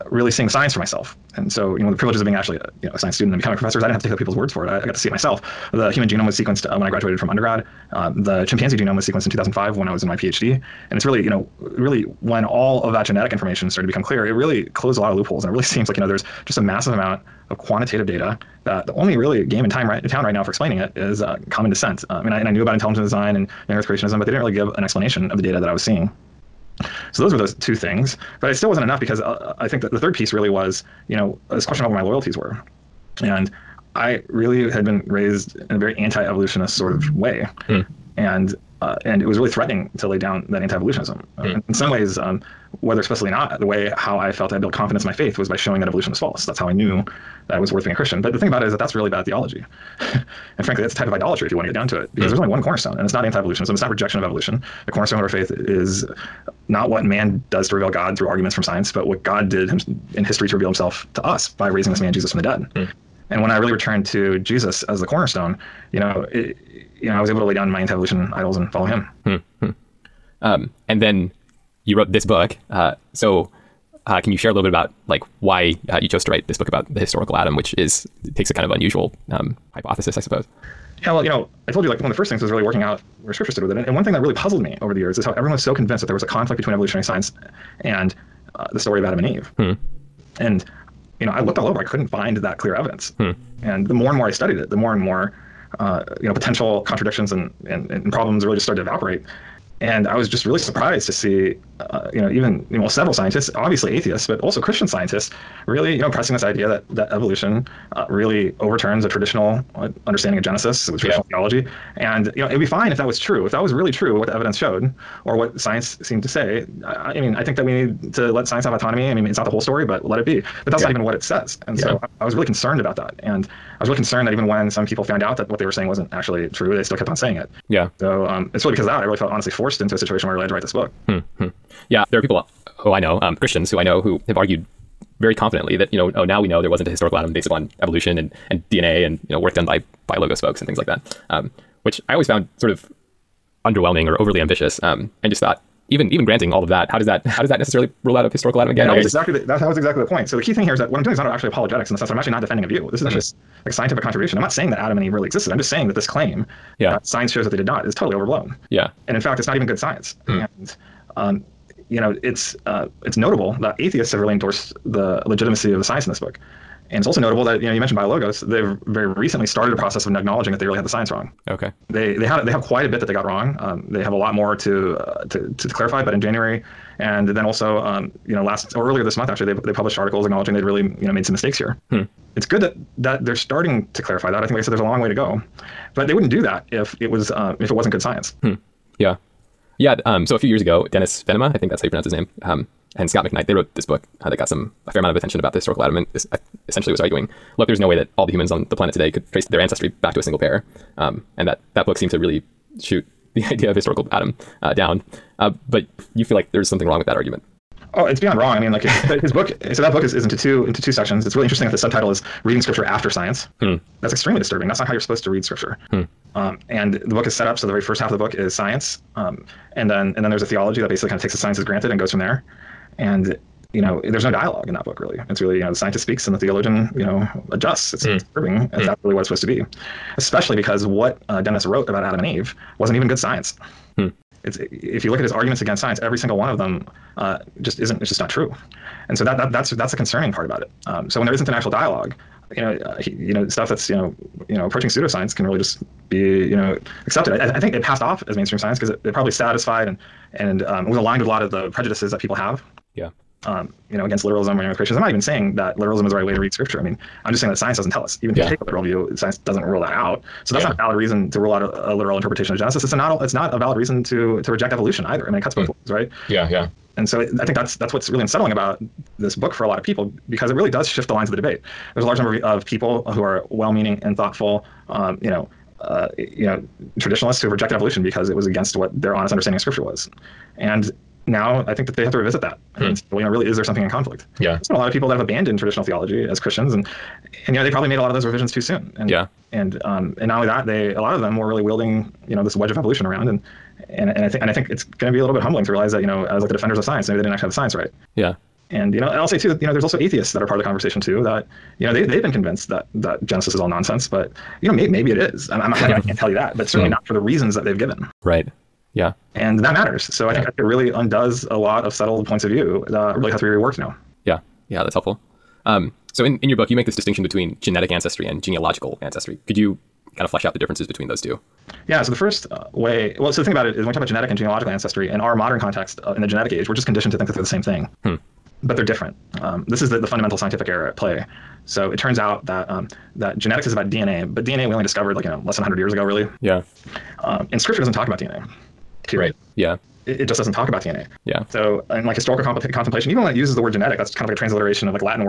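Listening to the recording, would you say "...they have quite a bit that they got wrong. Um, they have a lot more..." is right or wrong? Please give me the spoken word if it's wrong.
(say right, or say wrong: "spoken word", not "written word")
right.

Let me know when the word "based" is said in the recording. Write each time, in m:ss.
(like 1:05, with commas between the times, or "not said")
2:17.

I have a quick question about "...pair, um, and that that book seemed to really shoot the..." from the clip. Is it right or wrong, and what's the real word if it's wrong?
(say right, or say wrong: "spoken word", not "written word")
right.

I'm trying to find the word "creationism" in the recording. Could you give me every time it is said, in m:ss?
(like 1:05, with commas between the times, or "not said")
0:23, 4:14.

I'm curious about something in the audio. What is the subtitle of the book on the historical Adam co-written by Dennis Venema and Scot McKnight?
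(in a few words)
Reading Scripture After Science.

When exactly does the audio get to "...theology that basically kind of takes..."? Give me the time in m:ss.
3:40.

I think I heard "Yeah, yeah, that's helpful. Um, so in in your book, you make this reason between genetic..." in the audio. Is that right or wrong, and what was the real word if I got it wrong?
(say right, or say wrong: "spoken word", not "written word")
wrong: "distinction", not "reason".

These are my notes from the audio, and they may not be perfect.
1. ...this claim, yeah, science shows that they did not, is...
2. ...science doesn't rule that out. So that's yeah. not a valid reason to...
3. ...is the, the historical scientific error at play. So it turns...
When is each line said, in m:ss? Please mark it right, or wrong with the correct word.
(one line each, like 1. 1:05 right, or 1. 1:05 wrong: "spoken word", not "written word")
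1. 2:35 right
2. 4:19 right
3. 5:29 wrong: "fundamental", not "historical".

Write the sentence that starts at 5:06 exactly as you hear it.
not for the reasons that they've given.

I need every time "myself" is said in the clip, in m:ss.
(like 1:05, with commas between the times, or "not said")
0:00, 0:05.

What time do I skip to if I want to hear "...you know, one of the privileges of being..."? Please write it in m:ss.
0:01.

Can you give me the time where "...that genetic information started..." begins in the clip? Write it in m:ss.
0:12.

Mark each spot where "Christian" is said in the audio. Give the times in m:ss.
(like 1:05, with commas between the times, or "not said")
0:47, 1:44, 2:13, 4:46.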